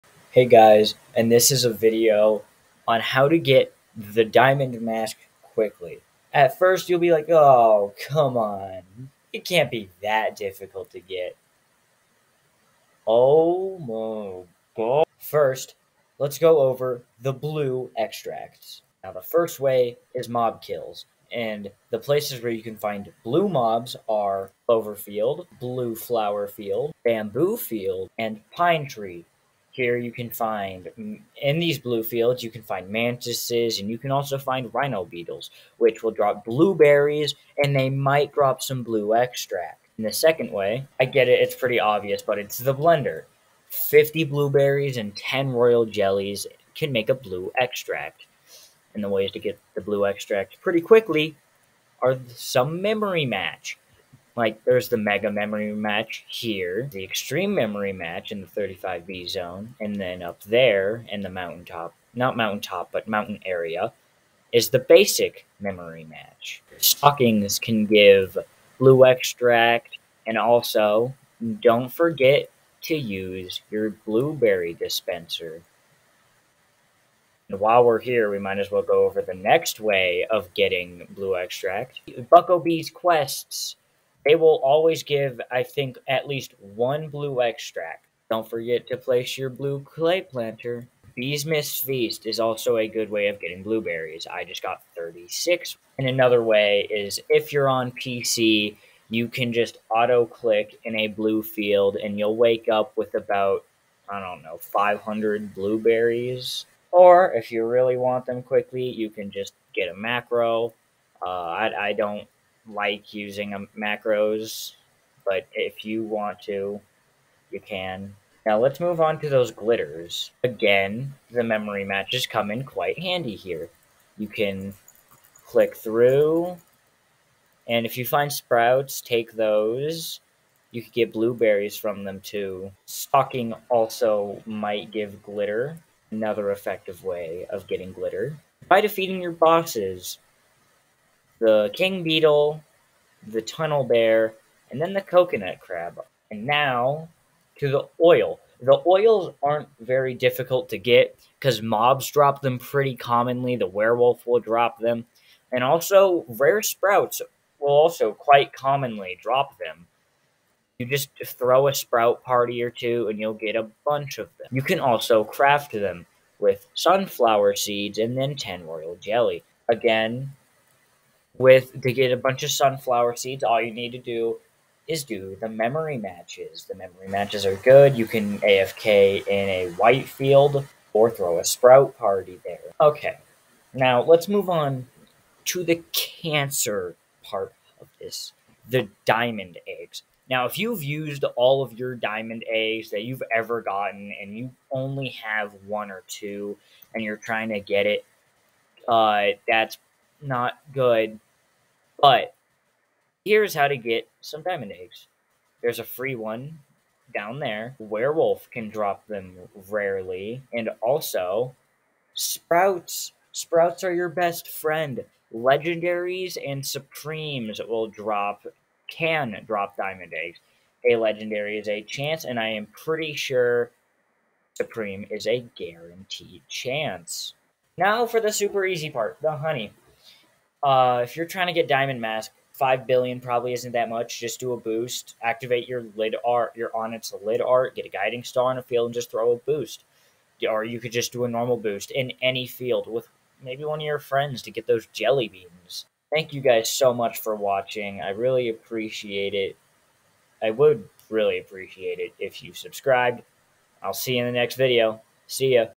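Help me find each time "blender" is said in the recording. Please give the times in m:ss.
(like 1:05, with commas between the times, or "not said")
0:42.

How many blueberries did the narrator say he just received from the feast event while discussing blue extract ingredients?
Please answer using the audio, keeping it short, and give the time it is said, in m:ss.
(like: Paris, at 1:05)
36, at 1:34.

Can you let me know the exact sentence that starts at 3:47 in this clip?
Now for the super easy part the honey.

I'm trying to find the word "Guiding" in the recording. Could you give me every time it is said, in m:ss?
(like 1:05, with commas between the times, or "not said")
3:57.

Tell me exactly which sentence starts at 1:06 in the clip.
Stockings can give blue extract, and also don't forget to use your blueberry dispenser.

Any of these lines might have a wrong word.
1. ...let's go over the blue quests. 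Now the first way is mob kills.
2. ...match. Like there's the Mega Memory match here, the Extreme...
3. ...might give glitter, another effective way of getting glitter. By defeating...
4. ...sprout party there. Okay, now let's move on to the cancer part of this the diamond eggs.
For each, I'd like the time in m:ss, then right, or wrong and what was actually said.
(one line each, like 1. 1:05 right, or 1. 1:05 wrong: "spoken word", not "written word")
1. 0:16 wrong: "extracts", not "quests"
2. 0:53 right
3. 2:14 right
4. 3:01 right.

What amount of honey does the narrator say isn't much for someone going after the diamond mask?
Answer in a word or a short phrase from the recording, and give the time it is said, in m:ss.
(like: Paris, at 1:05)
5 billion, at 3:52.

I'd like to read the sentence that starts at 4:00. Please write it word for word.
Or you could just do a normal boost in any field with maybe one of your friends to get those jelly beans.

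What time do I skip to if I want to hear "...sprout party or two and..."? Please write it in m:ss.
2:41.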